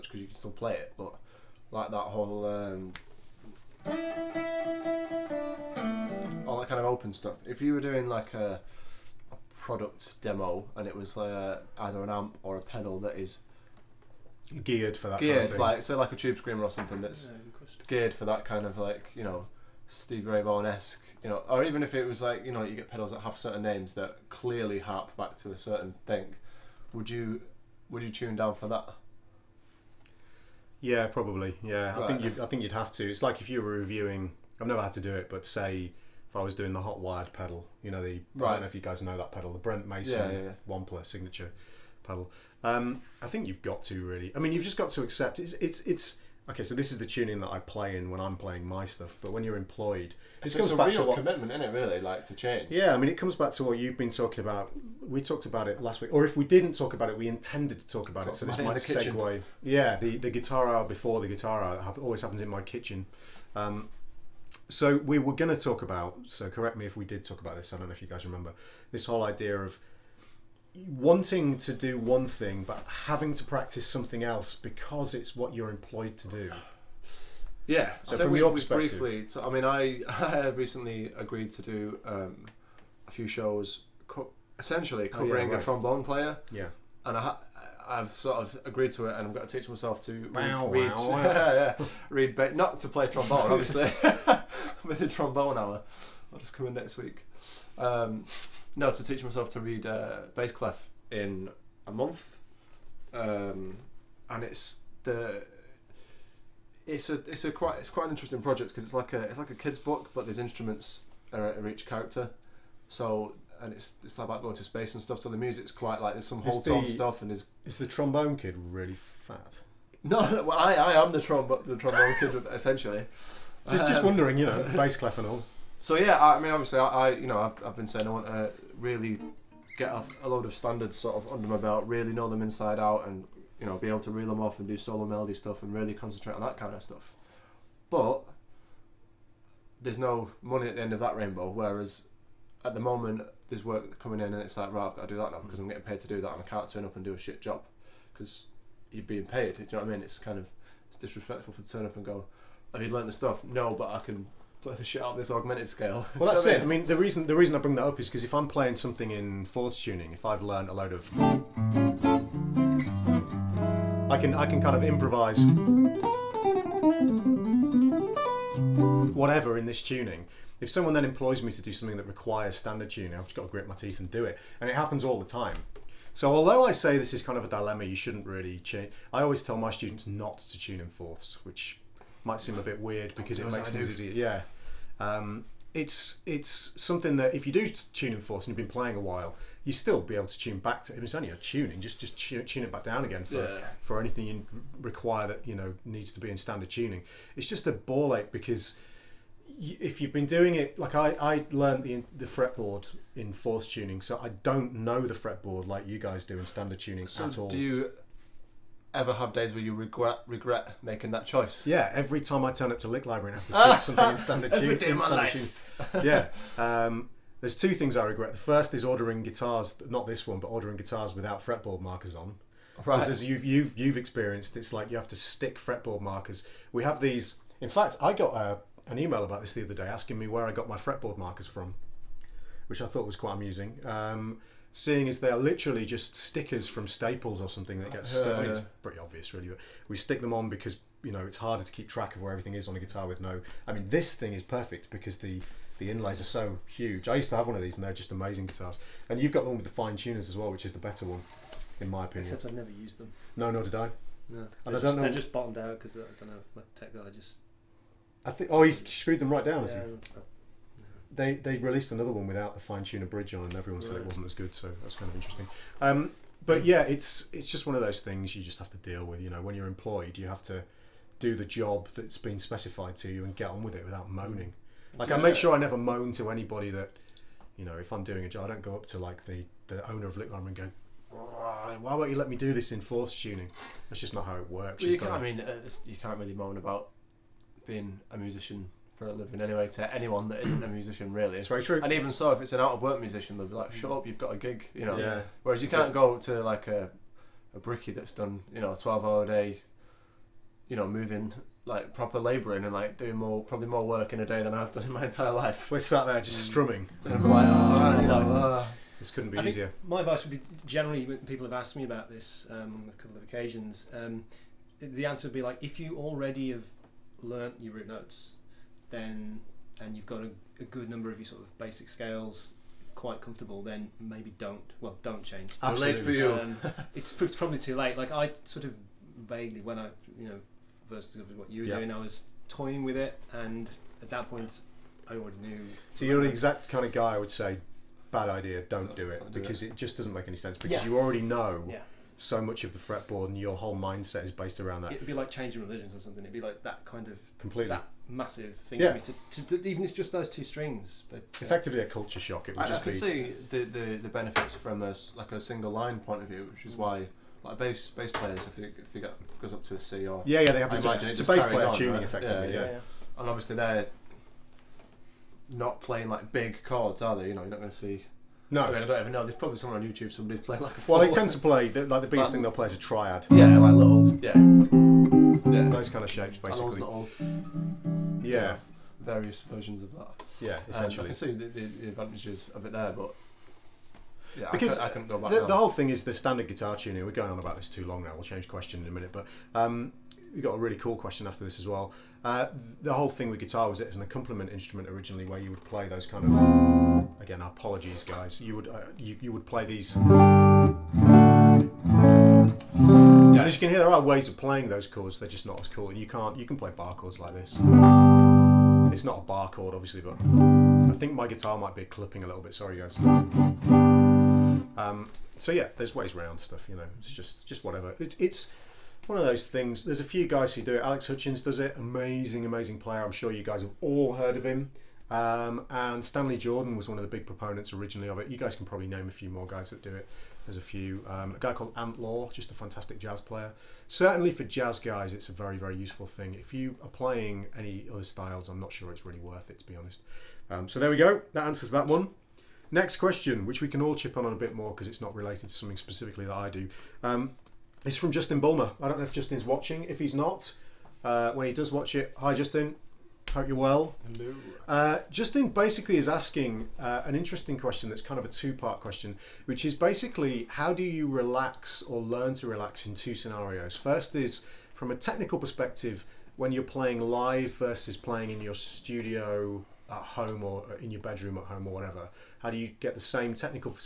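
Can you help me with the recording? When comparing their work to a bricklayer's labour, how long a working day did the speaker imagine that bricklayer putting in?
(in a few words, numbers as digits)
12 hours.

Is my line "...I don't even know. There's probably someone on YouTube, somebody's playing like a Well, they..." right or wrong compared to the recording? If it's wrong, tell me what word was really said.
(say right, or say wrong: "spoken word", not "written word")
right.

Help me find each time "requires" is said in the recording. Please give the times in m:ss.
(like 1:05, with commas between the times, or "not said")
2:52, 3:14.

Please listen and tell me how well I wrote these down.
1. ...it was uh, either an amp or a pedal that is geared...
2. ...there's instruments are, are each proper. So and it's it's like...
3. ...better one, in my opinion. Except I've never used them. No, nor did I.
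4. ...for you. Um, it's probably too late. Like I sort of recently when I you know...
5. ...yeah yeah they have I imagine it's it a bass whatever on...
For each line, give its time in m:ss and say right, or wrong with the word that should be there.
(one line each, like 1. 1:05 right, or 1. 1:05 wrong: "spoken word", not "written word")
1. 0:10 right
2. 1:50 wrong: "character", not "proper"
3. 4:10 right
4. 5:25 wrong: "vaguely", not "recently"
5. 6:00 wrong: "player", not "whatever".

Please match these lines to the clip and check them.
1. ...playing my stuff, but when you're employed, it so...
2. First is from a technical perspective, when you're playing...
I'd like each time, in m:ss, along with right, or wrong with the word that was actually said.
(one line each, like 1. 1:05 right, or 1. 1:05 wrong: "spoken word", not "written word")
1. 0:48 right
2. 7:43 right.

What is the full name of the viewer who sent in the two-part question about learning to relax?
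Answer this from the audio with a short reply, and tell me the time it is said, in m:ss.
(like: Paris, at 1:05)
Justin Bulmer, at 7:28.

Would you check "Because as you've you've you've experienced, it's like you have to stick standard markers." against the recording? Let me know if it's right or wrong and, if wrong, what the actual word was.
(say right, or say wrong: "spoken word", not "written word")
wrong: "fretboard", not "standard".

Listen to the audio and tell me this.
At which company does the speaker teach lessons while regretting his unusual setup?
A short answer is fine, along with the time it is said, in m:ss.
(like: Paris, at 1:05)
Lick Library, at 3:32.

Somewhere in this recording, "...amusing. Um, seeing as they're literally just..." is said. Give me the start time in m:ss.
3:53.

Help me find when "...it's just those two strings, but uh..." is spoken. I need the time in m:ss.
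5:49.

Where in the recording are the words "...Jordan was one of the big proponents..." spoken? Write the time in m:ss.
7:06.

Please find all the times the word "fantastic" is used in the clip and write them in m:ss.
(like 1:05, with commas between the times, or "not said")
7:12.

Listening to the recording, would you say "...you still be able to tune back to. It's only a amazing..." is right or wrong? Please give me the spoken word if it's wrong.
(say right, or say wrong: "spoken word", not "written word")
wrong: "tuning", not "amazing".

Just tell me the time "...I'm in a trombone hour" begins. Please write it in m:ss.
1:34.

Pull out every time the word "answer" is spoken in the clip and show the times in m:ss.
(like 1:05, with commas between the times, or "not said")
5:15, 7:21.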